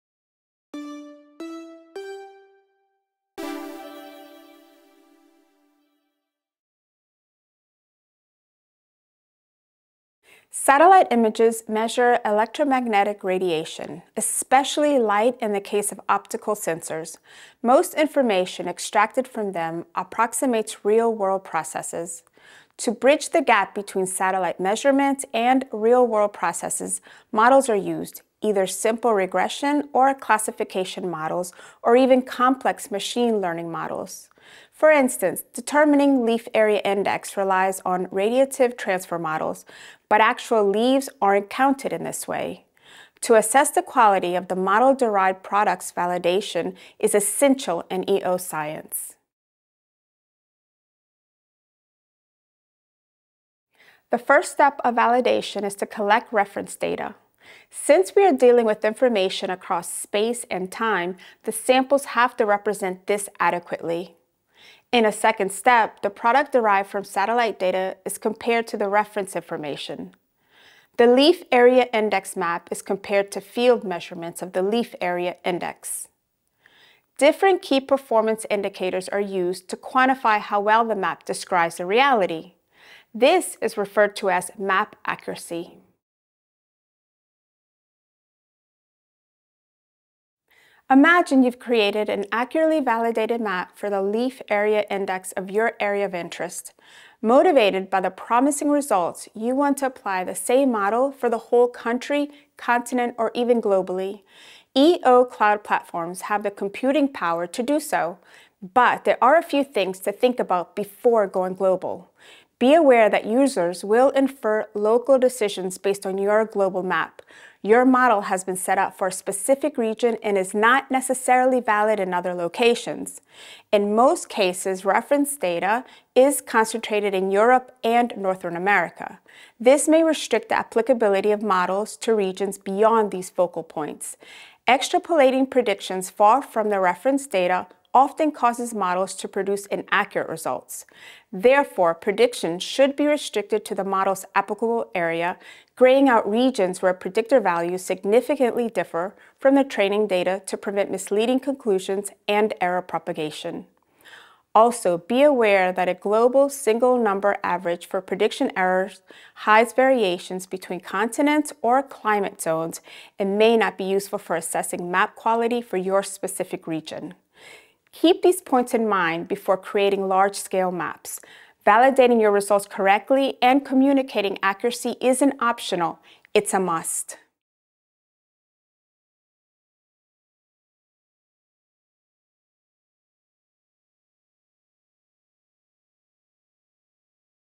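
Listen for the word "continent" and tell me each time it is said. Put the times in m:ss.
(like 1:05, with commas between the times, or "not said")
1:42, 2:40.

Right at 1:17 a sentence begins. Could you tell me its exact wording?
Different key performance indicators are used to quantify how well the map describes the reality.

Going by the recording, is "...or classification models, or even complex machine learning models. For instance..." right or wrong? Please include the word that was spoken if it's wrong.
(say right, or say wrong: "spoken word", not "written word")
right.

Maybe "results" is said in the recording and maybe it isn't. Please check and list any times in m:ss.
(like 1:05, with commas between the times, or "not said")
1:38, 2:20, 2:52.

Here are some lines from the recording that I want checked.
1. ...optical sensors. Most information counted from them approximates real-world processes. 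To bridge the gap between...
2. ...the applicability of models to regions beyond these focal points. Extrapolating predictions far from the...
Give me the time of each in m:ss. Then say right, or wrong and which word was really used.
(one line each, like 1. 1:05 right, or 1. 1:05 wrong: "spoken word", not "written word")
1. 0:16 wrong: "extracted", not "counted"
2. 2:10 right.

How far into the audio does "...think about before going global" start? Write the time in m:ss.
1:50.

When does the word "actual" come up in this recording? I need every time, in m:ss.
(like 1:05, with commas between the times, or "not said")
0:40.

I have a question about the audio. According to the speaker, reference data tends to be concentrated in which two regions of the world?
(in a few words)
Europe and Northern America.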